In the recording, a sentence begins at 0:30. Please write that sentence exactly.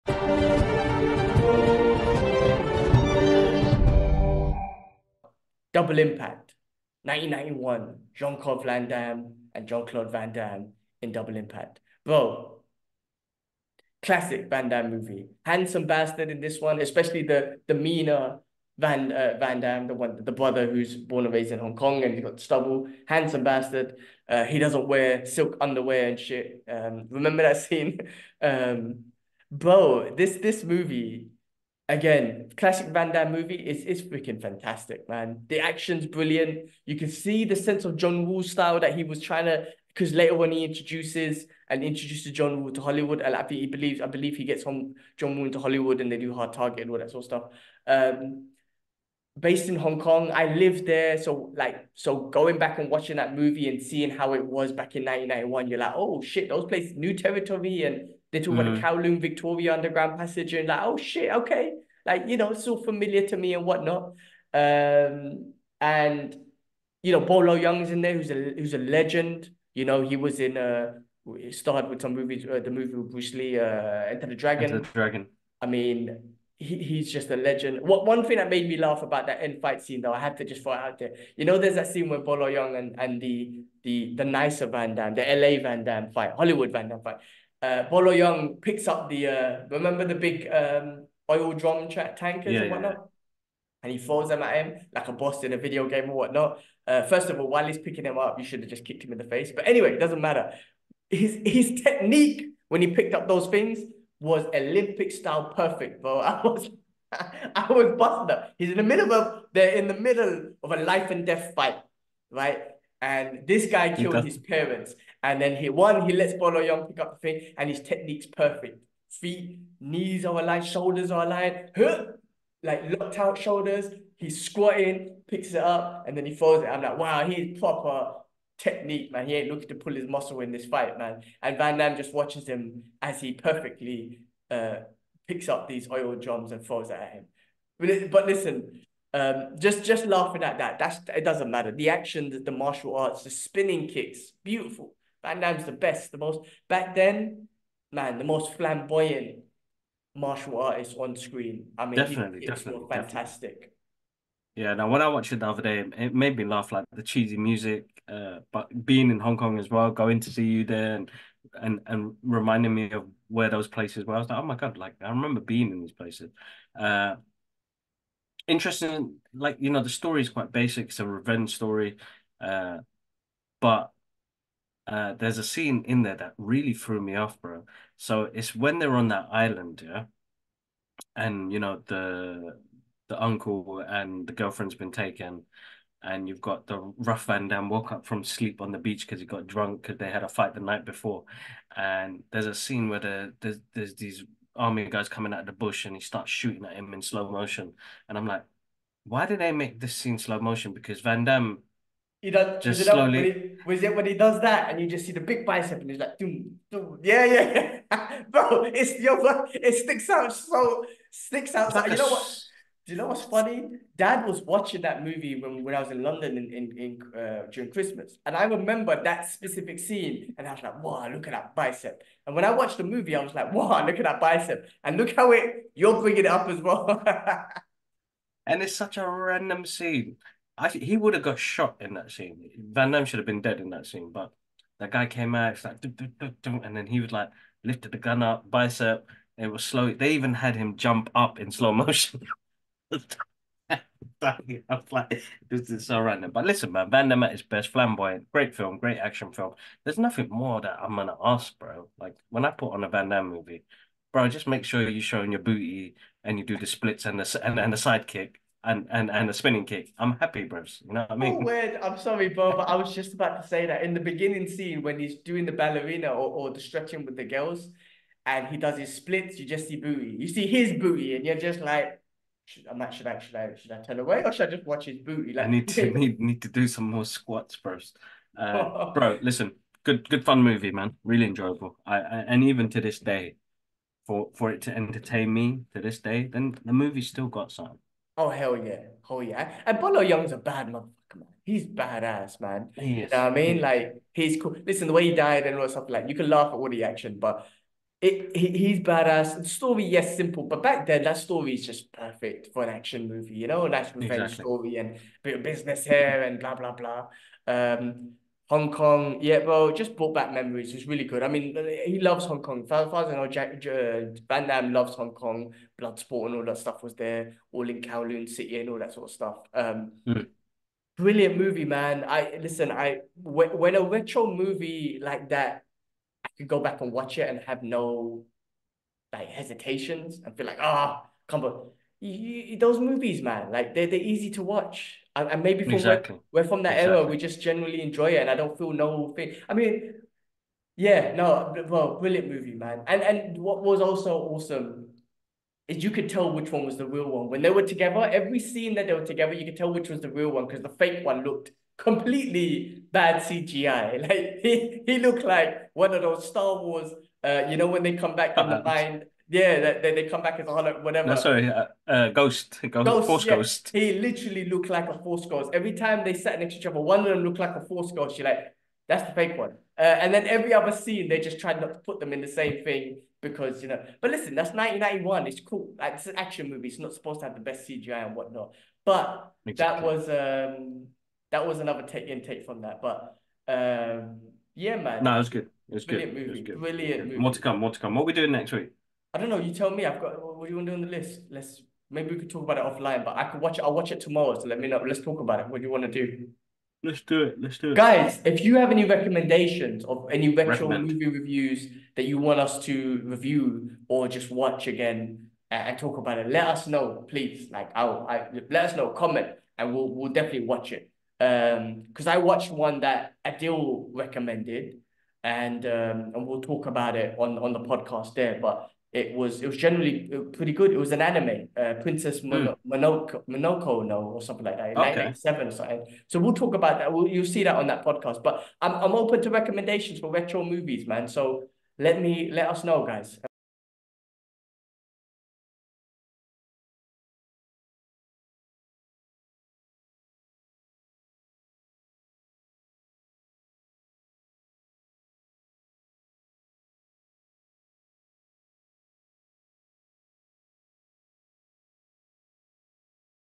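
This this movie again, classic Van Damme movie.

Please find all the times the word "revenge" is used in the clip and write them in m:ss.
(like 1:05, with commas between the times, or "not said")
2:51, 5:04.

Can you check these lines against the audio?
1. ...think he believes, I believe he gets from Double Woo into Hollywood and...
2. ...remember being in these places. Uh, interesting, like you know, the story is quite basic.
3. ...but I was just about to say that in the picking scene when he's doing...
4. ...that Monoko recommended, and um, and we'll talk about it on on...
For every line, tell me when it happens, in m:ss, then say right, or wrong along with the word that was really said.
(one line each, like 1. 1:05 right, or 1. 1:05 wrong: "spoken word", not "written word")
1. 0:43 wrong: "John", not "Double"
2. 2:45 right
3. 4:22 wrong: "beginning", not "picking"
4. 6:52 wrong: "Adil", not "Monoko".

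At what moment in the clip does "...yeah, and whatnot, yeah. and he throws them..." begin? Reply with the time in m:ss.
1:32.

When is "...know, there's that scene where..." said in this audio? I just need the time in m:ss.
1:21.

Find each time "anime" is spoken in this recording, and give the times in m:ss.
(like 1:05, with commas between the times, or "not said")
7:01.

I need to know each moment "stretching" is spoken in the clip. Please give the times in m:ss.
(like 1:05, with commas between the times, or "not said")
4:26.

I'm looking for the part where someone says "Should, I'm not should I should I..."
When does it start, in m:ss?
4:32.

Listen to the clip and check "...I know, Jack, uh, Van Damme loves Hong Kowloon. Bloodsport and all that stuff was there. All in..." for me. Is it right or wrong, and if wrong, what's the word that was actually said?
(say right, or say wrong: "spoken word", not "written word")
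wrong: "Kong", not "Kowloon".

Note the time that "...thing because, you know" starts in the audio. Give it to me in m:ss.
6:12.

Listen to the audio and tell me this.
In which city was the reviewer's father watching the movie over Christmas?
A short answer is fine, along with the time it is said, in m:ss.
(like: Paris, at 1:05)
London, at 3:36.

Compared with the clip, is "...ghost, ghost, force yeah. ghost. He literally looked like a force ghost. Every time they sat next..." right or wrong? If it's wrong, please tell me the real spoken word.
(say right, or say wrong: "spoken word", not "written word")
right.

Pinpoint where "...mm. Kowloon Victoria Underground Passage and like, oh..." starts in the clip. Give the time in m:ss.
0:58.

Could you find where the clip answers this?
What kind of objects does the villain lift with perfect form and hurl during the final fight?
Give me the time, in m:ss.
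2:15.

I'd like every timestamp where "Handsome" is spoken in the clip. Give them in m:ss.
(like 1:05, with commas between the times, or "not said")
0:15, 0:23.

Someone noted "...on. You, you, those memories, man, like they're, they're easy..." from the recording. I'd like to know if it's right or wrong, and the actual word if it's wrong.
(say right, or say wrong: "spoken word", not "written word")
wrong: "movies", not "memories".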